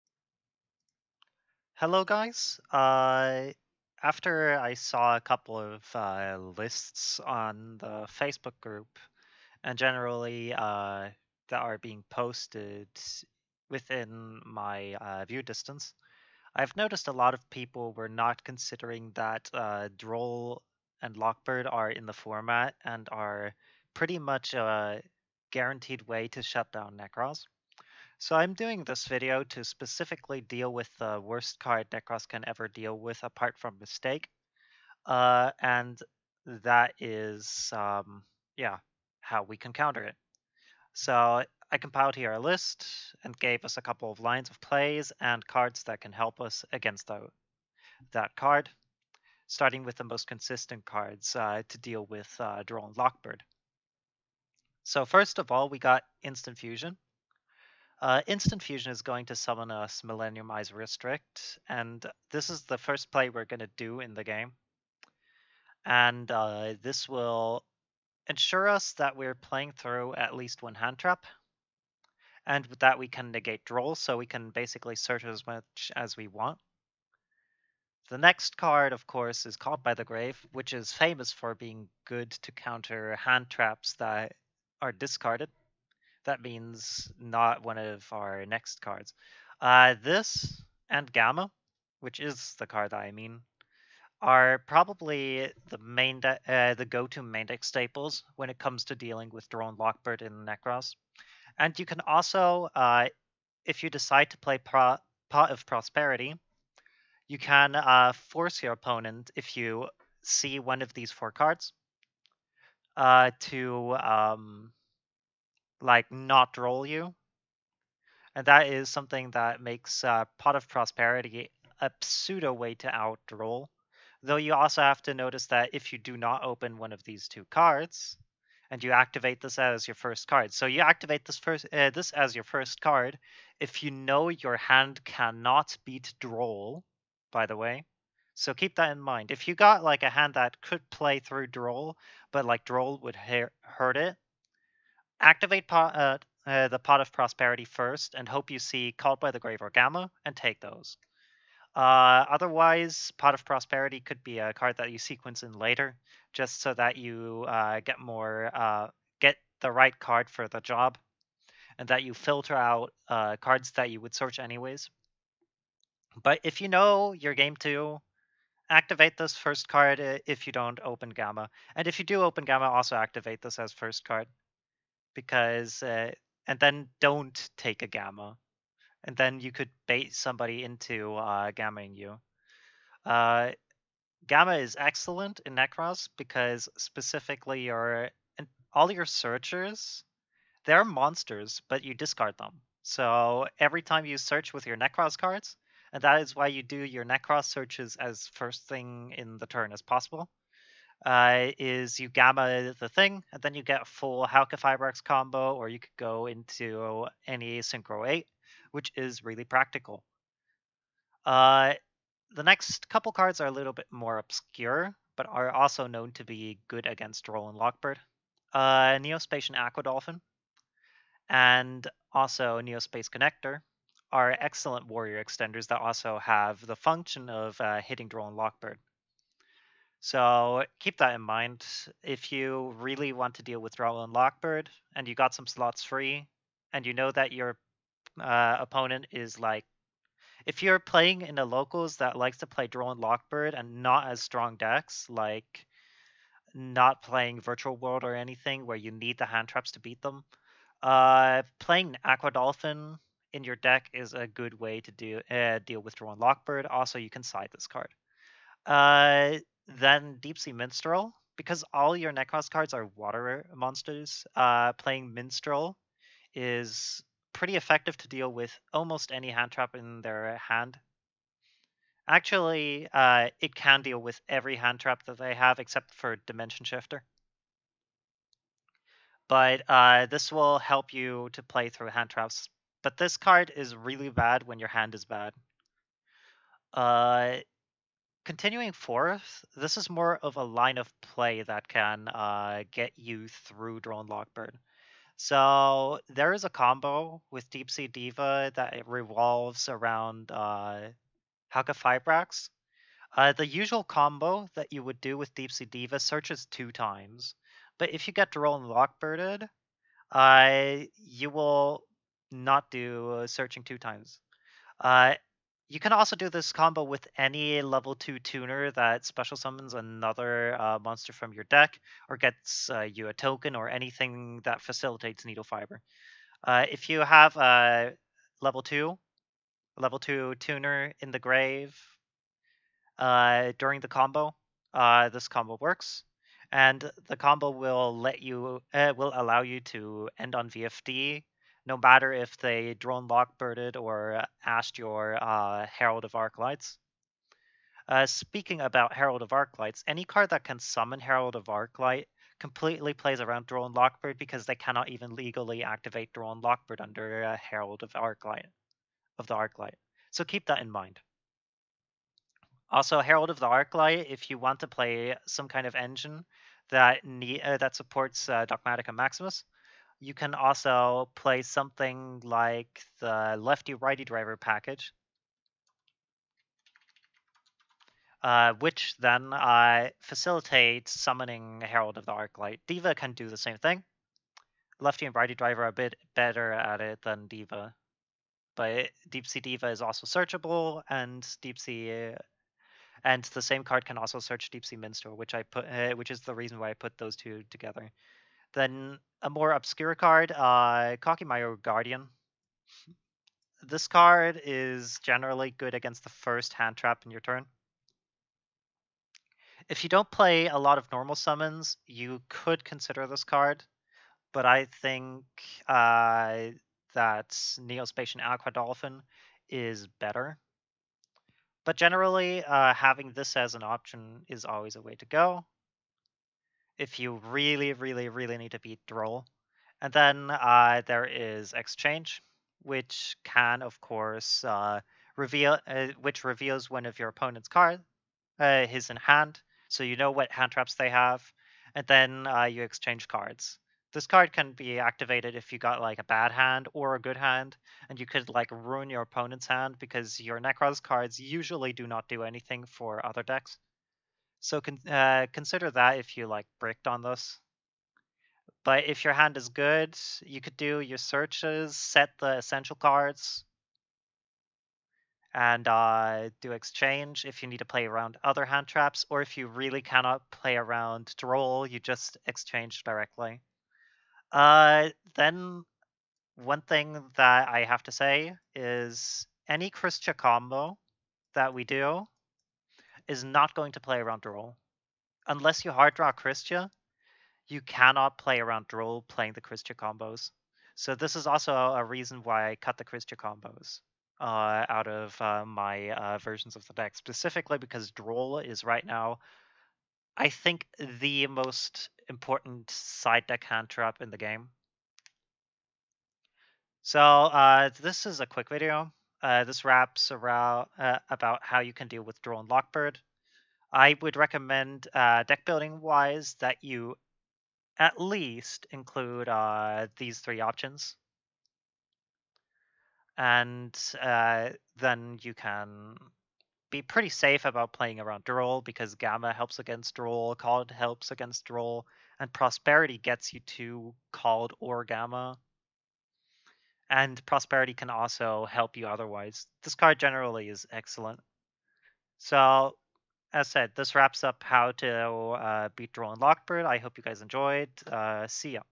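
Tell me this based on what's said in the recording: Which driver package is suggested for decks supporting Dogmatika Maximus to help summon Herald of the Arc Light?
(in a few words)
Lefty-righty driver.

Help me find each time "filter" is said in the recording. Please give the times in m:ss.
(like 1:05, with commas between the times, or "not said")
2:42.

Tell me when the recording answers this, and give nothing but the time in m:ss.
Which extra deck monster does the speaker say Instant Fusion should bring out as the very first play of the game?
1:00.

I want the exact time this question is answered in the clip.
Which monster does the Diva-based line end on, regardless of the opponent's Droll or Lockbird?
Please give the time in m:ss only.
5:40.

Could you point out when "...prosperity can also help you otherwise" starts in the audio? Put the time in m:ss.
8:57.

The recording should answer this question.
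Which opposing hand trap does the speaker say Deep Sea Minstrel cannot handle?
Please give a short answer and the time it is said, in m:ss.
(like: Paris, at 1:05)
Dimension Shifter, at 4:36.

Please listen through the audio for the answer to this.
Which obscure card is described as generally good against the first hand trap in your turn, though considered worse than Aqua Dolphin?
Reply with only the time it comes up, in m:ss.
6:41.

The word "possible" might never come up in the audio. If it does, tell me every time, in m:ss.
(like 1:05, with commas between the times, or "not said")
3:19.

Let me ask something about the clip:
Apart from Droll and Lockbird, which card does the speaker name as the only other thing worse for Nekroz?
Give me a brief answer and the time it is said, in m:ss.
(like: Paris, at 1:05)
Mistake, at 0:33.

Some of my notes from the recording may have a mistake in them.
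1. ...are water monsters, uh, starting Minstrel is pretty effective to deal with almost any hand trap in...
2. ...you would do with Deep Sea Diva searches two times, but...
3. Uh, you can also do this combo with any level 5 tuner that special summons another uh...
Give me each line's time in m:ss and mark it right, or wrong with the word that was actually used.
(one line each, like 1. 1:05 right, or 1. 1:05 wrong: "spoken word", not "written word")
1. 4:22 wrong: "playing", not "starting"
2. 5:04 right
3. 5:14 wrong: "2", not "5".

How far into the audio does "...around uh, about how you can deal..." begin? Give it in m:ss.
8:30.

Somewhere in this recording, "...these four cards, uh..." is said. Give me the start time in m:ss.
1:50.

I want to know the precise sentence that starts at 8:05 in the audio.
Unless you hard draw Kristya, you cannot play around Droll playing the Kristya combos.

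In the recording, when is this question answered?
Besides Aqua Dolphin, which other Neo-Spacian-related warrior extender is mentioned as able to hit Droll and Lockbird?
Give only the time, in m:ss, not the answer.
3:42.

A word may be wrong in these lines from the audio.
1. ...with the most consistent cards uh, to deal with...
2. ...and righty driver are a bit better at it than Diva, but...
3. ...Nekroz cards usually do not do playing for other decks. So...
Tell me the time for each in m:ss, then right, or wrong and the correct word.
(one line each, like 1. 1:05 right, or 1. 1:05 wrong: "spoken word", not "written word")
1. 0:49 right
2. 6:25 right
3. 7:30 wrong: "anything", not "playing".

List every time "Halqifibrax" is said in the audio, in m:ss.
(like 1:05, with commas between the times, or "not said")
3:24, 5:01.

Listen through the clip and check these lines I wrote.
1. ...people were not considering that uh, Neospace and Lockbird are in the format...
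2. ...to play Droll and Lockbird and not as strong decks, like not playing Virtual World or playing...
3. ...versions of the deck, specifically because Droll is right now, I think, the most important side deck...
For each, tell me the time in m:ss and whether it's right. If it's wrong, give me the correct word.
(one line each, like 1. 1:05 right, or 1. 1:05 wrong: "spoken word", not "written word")
1. 0:17 wrong: "Droll", not "Neospace"
2. 4:02 wrong: "anything", not "playing"
3. 8:16 right.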